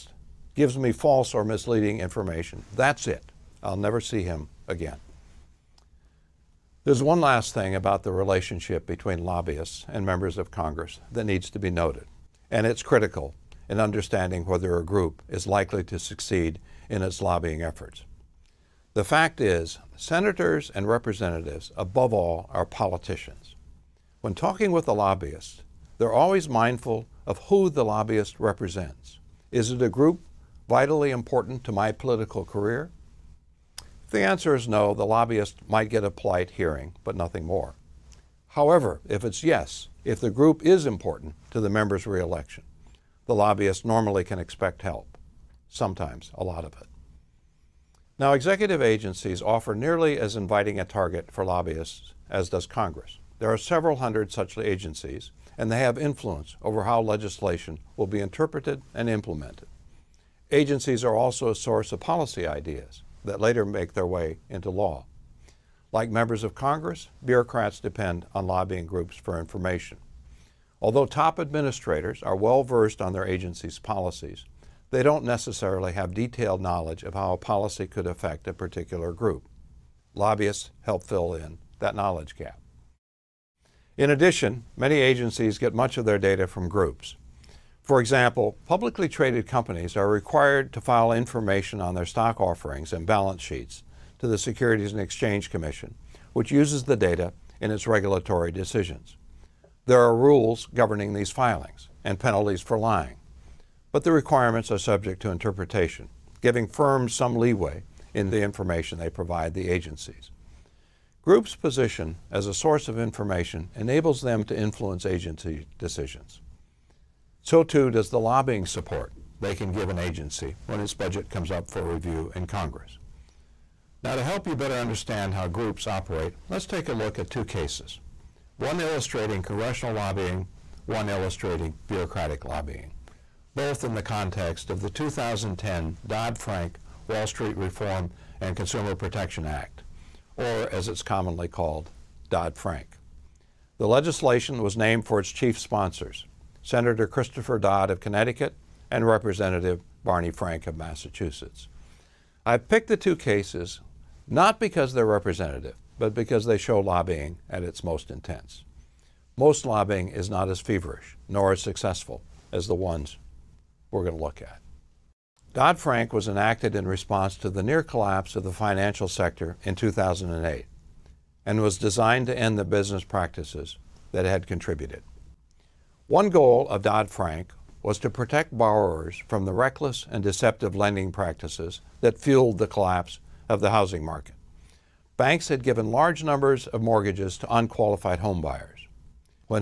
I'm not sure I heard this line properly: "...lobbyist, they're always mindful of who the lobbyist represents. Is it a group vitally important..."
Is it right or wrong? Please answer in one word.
right.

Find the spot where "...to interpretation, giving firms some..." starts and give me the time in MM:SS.
01:45.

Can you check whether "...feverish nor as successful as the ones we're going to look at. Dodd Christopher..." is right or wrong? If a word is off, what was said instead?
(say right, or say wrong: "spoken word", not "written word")
wrong: "Frank", not "Christopher".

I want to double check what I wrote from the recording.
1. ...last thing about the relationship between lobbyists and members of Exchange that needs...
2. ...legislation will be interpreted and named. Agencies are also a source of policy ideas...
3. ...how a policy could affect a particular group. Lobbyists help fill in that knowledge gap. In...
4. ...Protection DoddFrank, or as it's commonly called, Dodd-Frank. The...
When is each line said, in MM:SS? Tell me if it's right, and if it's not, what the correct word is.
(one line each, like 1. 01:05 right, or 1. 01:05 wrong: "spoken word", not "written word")
1. 00:07 wrong: "Congress", not "Exchange"
2. 00:57 wrong: "implemented", not "named"
3. 01:17 right
4. 02:18 wrong: "Act", not "DoddFrank".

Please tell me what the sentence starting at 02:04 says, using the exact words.
Now to help you better understand how groups operate, let's take a look at two cases.